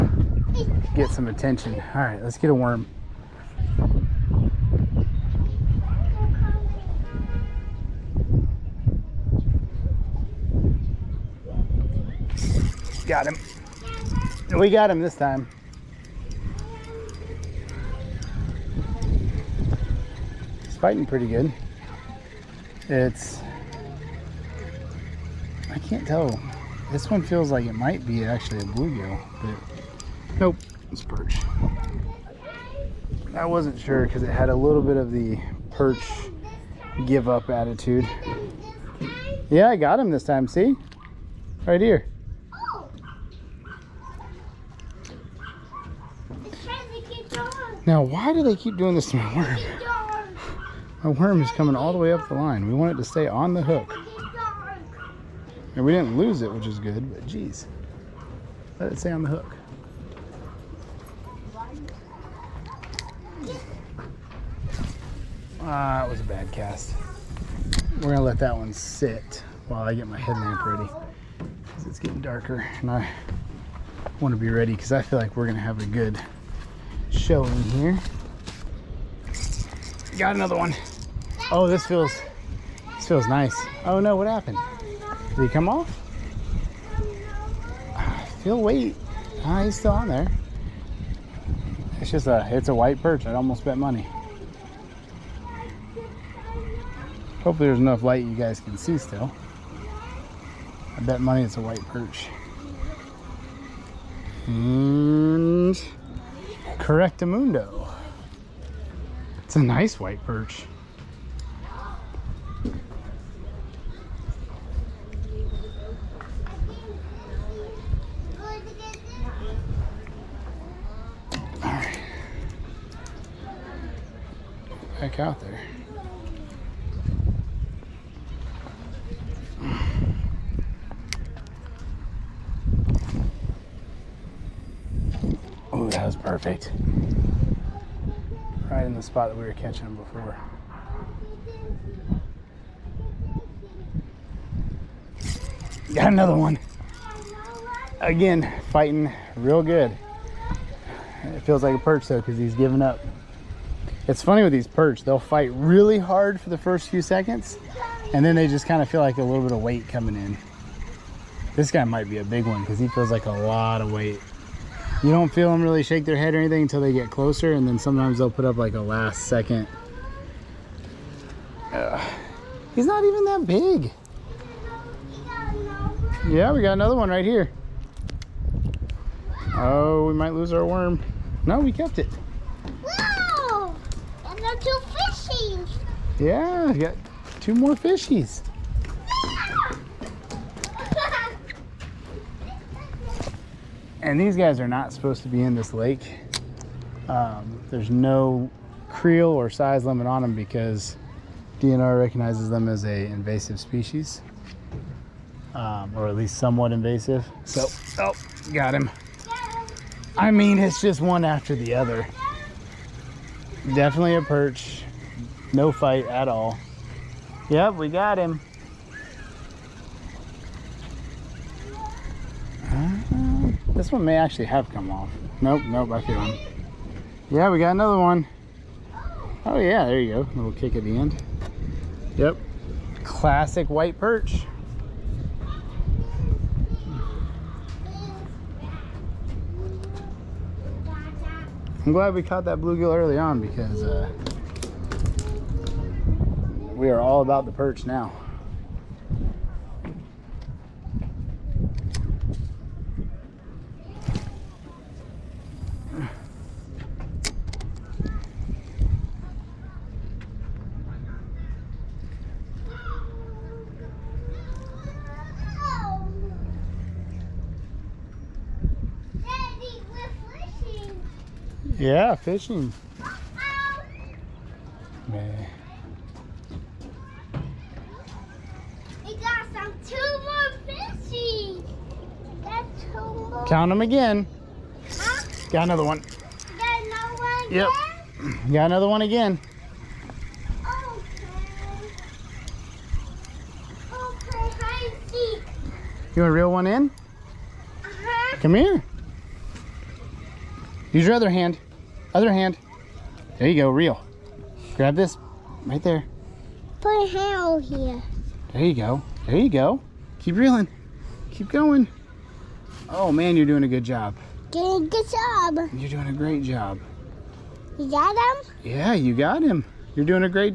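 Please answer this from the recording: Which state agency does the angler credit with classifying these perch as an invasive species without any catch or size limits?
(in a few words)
DNR.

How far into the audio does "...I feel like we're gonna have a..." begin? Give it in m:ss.
1:14.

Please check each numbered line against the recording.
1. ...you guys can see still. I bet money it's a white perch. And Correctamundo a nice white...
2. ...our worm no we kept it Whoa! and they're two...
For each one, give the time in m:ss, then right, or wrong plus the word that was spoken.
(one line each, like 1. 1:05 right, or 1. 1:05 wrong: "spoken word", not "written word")
1. 1:38 right
2. 3:00 right.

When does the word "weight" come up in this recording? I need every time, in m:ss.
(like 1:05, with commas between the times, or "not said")
1:28, 2:39, 2:43.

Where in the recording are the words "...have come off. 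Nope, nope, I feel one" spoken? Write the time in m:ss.
3:44.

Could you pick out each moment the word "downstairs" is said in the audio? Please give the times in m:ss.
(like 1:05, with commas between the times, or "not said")
not said.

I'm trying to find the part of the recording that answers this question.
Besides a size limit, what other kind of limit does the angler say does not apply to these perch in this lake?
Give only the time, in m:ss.
3:18.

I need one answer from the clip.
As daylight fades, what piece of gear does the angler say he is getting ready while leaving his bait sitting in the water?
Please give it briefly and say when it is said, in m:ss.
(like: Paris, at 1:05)
headlamp, at 1:10.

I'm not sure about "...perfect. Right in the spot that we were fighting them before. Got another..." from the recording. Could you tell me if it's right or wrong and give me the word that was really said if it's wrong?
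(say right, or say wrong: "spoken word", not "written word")
wrong: "catching", not "fighting".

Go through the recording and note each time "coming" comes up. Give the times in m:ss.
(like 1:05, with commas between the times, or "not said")
0:51, 2:39.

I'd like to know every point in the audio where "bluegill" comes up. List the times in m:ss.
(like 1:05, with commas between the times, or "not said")
0:28, 4:02.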